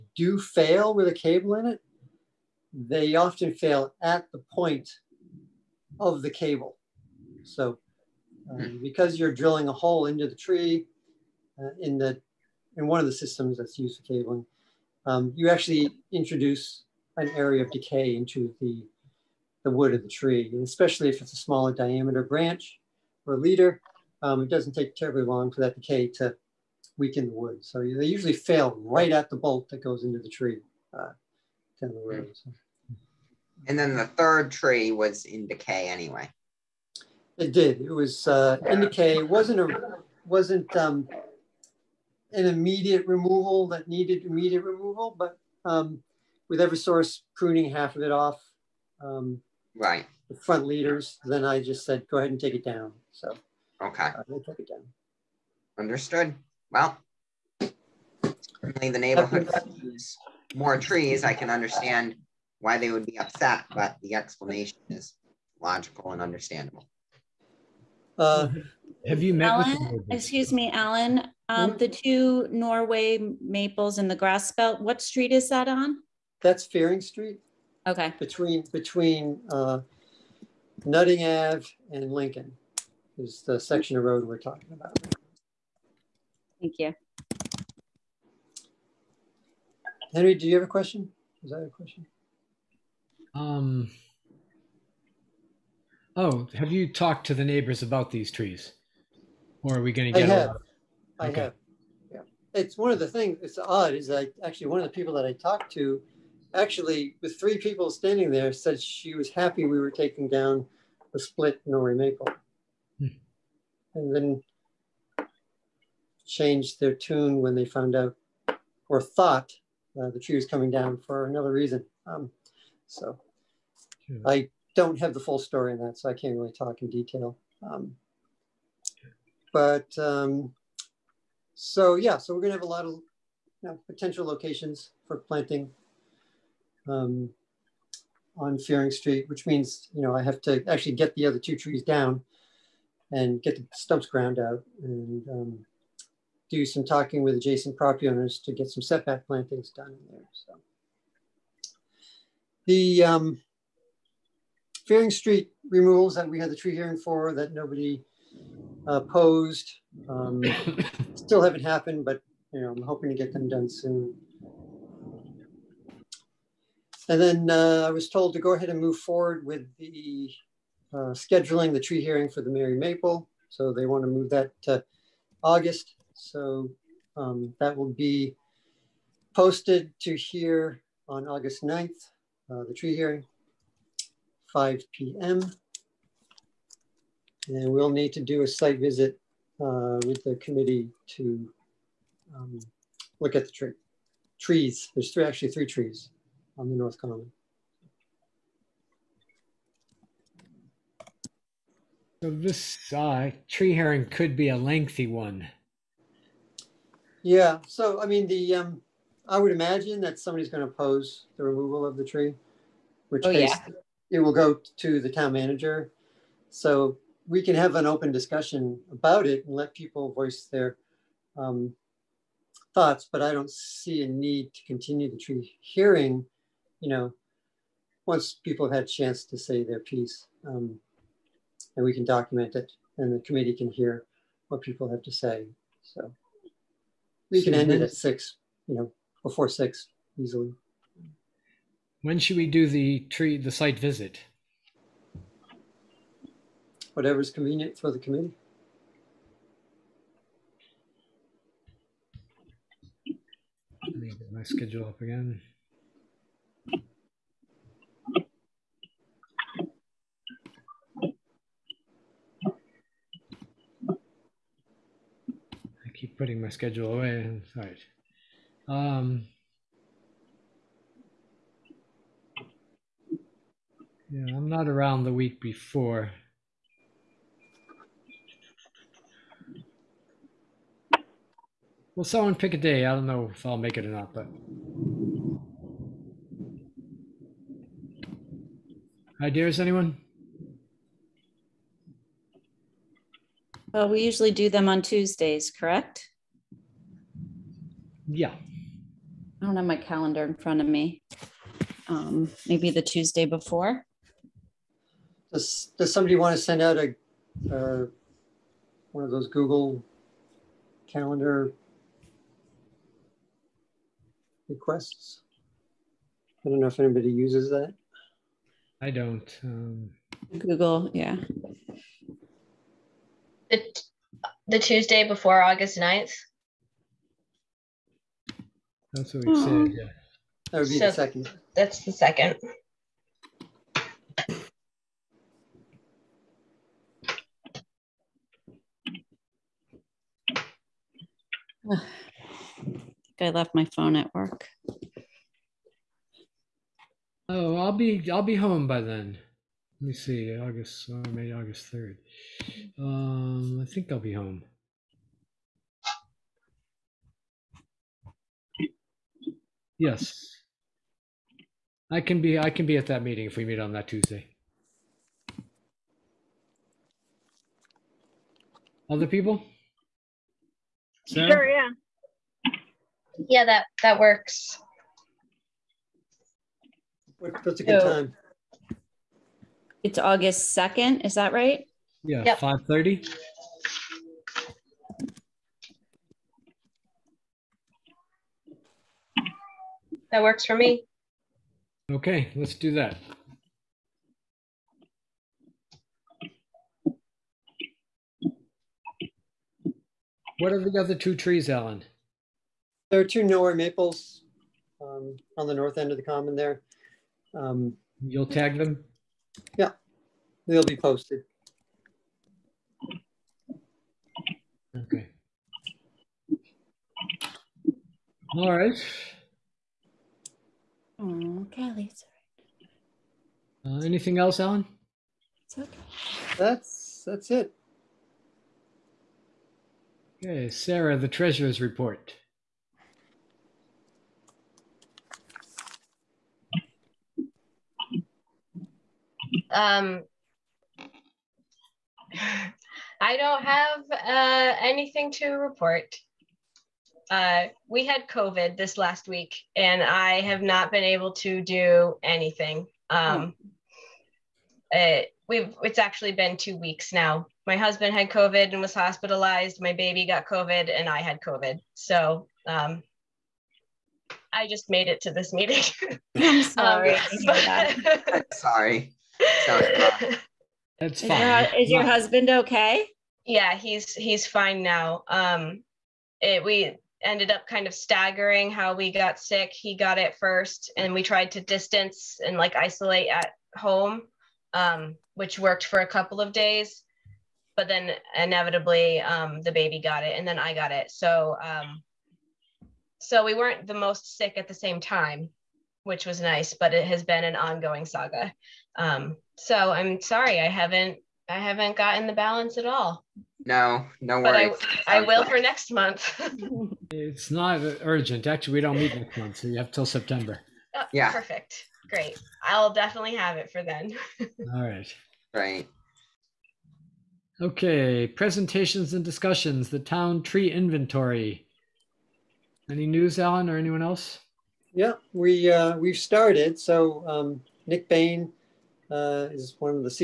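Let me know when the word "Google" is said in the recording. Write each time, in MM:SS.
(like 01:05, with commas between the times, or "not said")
05:09, 05:20.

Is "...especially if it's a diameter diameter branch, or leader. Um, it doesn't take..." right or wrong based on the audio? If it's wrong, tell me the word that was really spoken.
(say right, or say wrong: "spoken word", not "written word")
wrong: "smaller", not "diameter".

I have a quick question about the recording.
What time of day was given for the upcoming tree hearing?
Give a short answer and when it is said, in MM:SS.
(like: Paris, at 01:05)
5 p.m., at 03:04.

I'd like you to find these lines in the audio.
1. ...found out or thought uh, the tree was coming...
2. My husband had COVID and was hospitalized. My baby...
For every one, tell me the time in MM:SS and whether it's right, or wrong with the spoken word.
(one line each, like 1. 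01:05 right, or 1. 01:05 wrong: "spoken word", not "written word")
1. 01:57 right
2. 07:37 right.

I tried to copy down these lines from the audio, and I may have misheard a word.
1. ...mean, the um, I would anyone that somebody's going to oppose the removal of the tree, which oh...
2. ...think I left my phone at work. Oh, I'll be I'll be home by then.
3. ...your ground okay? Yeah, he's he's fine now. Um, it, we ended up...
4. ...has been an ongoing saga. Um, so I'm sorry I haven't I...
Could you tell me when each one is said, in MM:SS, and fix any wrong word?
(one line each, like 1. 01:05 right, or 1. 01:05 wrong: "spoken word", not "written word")
1. 03:28 wrong: "imagine", not "anyone"
2. 05:42 right
3. 07:51 wrong: "husband", not "ground"
4. 08:16 right.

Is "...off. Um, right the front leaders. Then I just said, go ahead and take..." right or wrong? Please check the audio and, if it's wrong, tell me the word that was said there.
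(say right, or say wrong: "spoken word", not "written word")
right.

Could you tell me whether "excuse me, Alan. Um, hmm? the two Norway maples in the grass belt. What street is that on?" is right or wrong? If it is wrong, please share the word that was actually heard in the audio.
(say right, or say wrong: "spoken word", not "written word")
right.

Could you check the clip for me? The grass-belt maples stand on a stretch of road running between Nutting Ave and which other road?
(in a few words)
Lincoln.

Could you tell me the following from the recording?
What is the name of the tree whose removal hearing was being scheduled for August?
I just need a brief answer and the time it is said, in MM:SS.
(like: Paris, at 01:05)
Merry Maple, at 02:52.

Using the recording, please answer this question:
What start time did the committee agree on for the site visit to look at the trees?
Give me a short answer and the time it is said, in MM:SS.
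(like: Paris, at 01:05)
5:30, at 06:22.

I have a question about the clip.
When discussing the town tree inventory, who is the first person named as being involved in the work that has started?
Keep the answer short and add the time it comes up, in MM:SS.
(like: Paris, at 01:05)
Nick Bain, at 08:47.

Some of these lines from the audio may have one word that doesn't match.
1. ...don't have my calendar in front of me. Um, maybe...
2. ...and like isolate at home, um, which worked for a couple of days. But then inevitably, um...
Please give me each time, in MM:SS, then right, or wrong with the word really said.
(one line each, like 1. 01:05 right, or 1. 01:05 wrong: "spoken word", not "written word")
1. 04:59 right
2. 08:02 right.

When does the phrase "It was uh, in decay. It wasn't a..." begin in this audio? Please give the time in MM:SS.
00:37.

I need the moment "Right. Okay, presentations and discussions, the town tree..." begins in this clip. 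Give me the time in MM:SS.
08:35.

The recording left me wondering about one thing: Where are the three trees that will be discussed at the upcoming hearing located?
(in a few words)
North Common.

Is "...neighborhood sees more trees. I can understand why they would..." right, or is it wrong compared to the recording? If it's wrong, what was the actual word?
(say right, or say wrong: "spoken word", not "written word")
right.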